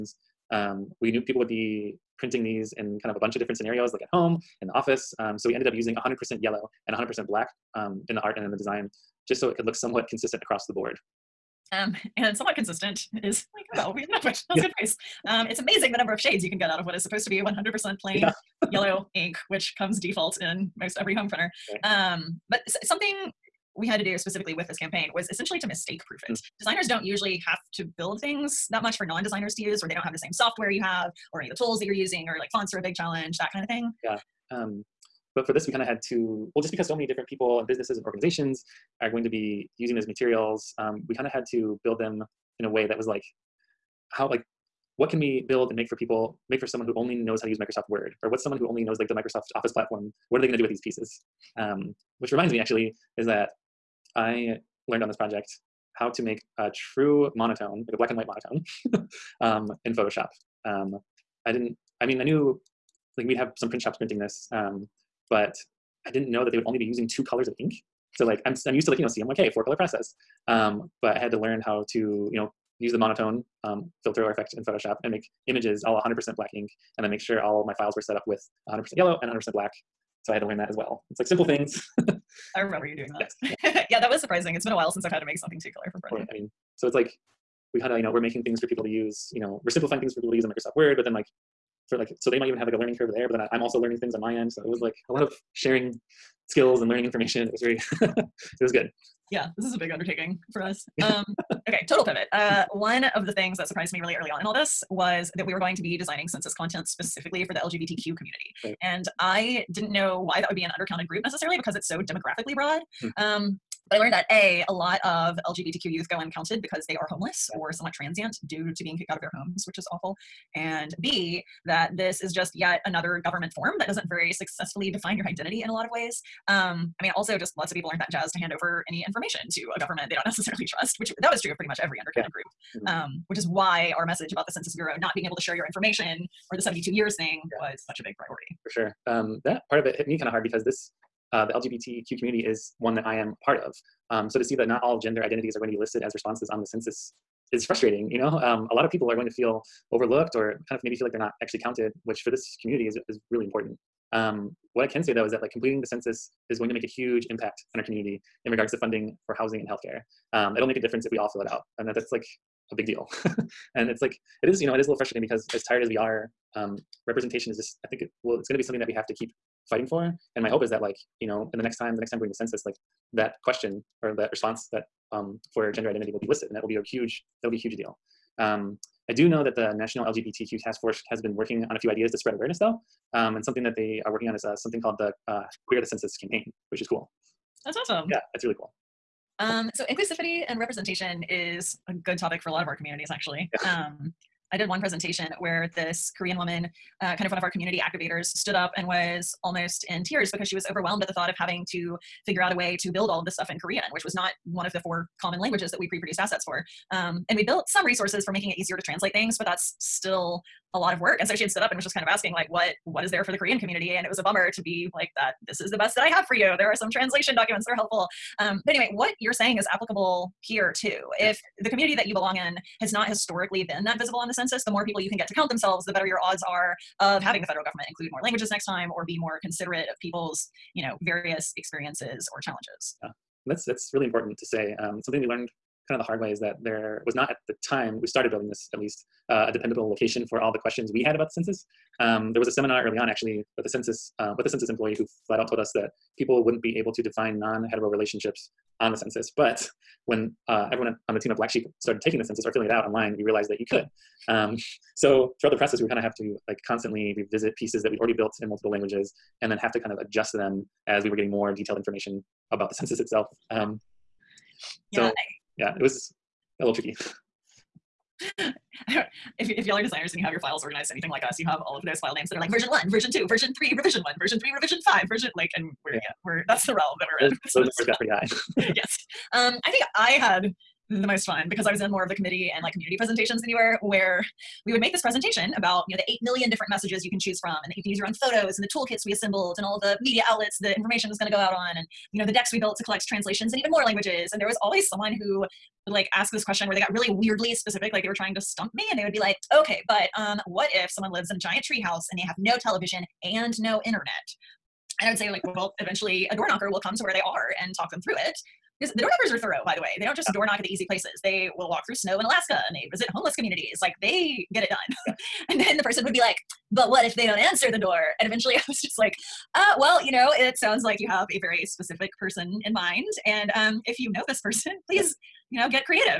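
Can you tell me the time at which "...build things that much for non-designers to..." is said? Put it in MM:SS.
00:27.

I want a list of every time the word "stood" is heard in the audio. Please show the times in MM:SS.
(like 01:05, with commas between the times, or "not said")
03:18, 03:31.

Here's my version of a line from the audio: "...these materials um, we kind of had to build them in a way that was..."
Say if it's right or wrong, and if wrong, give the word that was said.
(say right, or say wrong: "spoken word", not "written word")
right.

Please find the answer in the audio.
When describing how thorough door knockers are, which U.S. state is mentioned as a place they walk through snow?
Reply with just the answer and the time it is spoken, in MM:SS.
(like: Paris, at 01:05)
Alaska, at 05:12.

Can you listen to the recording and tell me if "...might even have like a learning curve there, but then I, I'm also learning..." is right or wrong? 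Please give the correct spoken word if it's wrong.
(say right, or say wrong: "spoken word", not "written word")
right.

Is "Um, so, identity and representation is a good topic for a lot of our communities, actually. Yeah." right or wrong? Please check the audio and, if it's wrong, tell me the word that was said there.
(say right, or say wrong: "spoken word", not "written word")
wrong: "inclusivity", not "identity".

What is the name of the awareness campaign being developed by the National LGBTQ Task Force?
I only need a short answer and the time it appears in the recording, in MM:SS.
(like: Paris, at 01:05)
Queer the Census, at 03:05.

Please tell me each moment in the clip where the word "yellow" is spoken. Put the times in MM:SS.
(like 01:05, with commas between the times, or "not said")
00:06, 00:18, 01:18.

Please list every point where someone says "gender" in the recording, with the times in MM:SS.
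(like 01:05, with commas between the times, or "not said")
02:24, 02:55.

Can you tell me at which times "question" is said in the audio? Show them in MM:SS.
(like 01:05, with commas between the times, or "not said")
02:53, 04:00, 04:56.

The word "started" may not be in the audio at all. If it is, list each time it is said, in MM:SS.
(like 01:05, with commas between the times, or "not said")
03:58, 04:11.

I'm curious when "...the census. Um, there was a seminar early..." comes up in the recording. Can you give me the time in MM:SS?
04:01.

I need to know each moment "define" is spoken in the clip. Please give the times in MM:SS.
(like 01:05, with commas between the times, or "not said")
02:04, 04:07.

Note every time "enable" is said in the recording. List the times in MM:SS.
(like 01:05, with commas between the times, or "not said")
not said.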